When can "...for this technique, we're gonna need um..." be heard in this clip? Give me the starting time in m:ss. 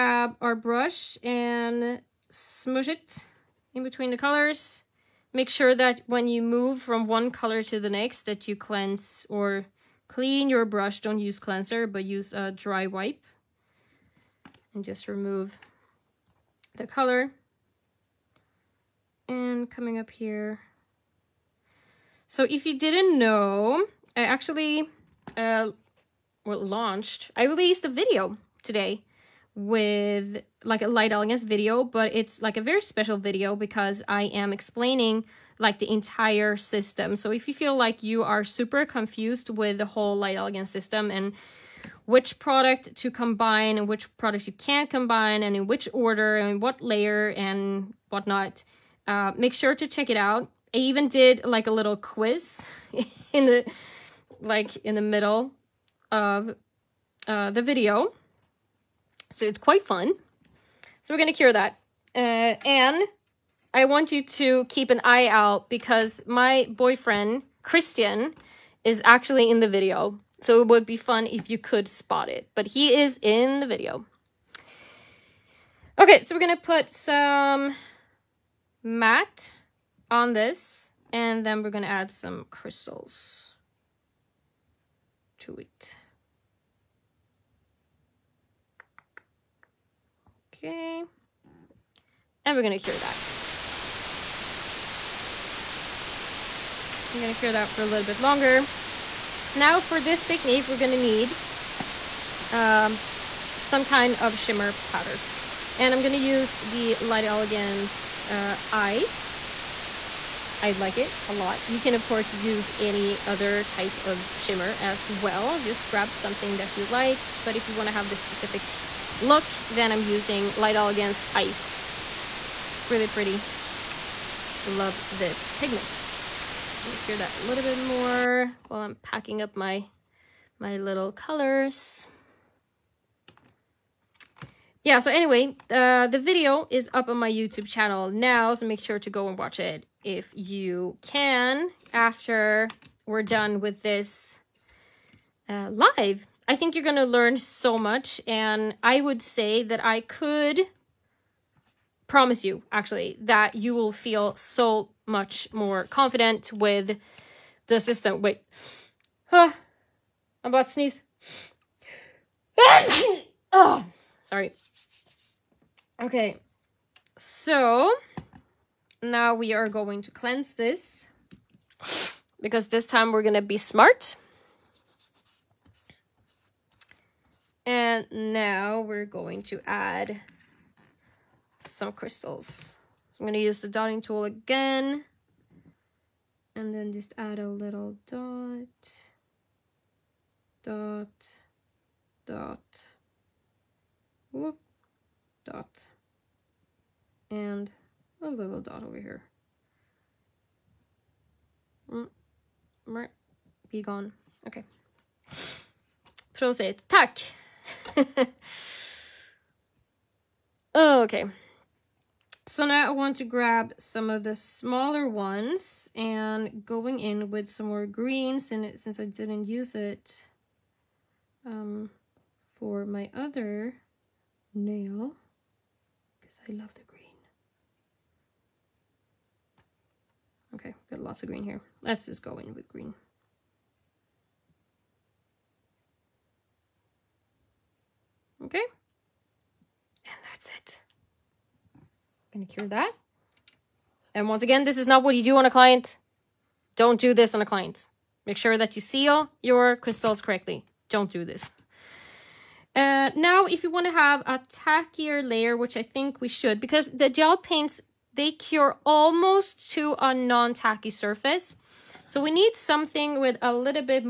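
1:39.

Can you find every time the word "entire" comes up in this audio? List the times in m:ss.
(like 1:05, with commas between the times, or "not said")
0:35.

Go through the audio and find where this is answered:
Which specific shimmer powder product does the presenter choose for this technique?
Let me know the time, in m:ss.
1:47.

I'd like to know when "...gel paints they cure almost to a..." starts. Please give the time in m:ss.
4:17.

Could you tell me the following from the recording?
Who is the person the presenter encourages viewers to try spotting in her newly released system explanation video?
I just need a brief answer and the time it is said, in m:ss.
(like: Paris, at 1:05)
Christian, at 1:07.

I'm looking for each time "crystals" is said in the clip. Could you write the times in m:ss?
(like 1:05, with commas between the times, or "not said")
1:22, 3:01, 4:09.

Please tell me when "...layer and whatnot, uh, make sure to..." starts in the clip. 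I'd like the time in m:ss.
0:46.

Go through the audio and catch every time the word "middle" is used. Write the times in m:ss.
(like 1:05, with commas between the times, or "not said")
0:55.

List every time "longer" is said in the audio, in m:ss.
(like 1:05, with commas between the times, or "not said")
1:38.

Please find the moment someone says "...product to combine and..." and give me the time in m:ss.
0:42.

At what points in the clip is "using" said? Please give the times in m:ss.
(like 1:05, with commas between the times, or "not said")
2:00.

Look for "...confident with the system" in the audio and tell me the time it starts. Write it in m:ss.
2:35.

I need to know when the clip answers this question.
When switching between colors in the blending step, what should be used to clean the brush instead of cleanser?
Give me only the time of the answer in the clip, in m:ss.
0:12.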